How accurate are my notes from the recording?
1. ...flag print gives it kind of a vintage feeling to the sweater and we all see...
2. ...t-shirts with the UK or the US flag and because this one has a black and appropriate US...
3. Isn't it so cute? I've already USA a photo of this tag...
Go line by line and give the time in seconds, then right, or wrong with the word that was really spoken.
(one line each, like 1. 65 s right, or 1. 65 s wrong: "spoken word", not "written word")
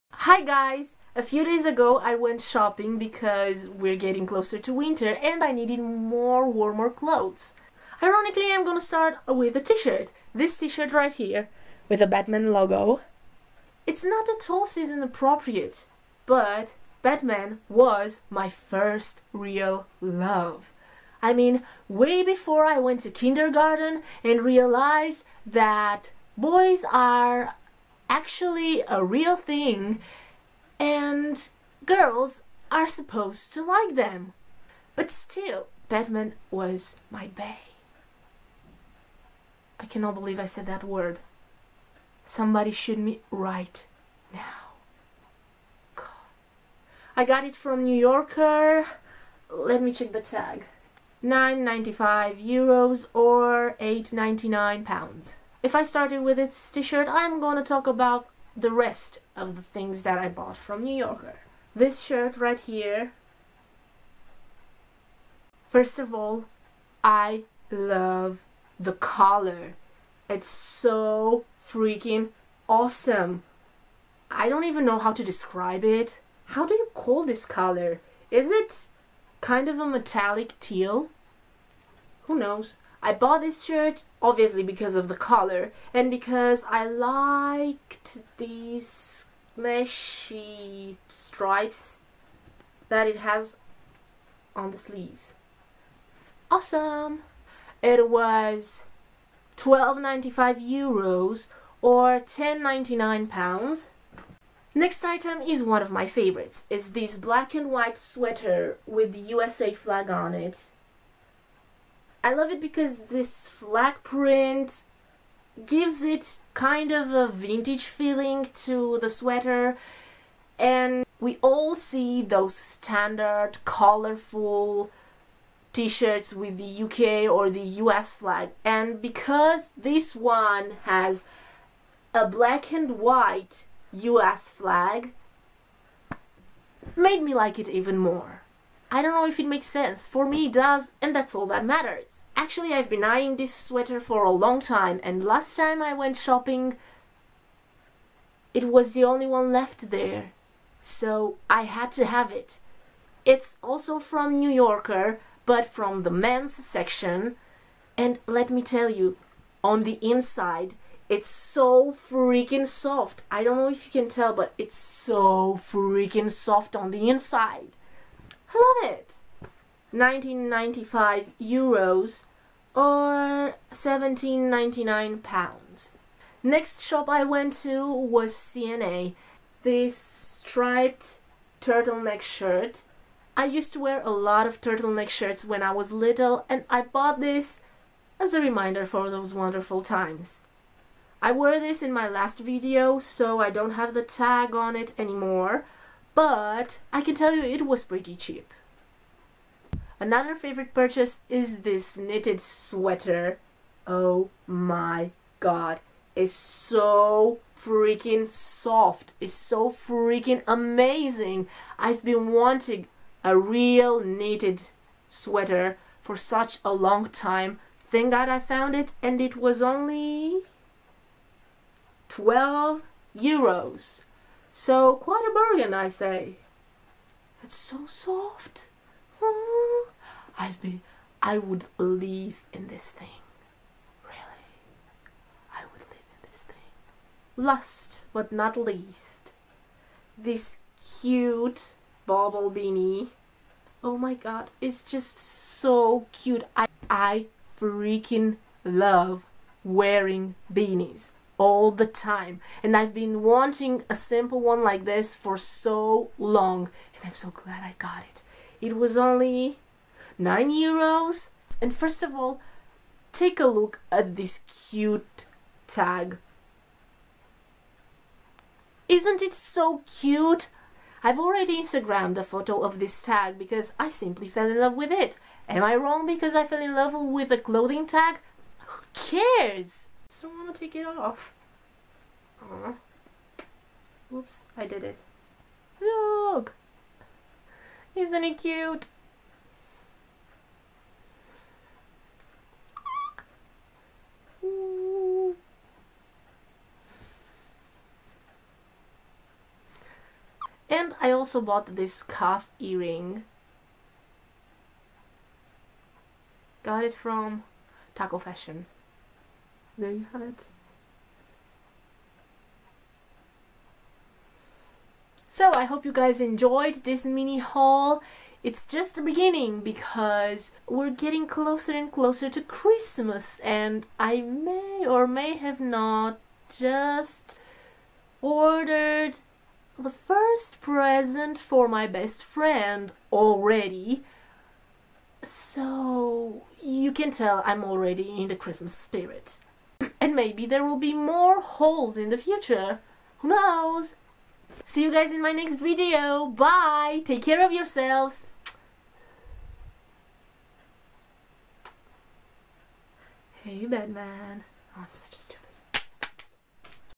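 1. 113 s right
2. 125 s wrong: "white", not "appropriate"
3. 268 s wrong: "Instagrammed", not "USA".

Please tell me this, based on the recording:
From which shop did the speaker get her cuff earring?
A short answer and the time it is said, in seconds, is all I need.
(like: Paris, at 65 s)
Takko Fashion, at 307 s.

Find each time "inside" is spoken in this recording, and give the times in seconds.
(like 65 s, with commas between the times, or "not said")
160 s, 167 s.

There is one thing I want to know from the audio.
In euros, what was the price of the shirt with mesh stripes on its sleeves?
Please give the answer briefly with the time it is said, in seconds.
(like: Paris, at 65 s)
12.95 euros, at 99 s.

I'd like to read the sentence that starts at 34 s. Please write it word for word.
But still, Batman was my bae.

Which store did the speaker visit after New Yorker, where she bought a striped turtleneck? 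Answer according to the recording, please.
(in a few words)
C&A.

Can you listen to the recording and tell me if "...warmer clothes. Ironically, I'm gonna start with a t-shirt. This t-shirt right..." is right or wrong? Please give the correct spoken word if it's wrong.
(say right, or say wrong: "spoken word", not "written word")
right.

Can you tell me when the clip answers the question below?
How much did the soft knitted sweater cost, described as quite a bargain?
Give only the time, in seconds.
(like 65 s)
222 s.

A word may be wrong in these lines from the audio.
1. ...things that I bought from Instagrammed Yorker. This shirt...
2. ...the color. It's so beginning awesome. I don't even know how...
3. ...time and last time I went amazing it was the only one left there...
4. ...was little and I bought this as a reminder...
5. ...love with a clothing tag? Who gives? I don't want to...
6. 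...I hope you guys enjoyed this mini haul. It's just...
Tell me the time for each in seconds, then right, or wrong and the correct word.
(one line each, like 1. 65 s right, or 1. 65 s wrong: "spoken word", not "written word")
1. 59 s wrong: "New", not "Instagrammed"
2. 68 s wrong: "freaking", not "beginning"
3. 144 s wrong: "shopping", not "amazing"
4. 185 s right
5. 276 s wrong: "cares", not "gives"
6. 315 s right.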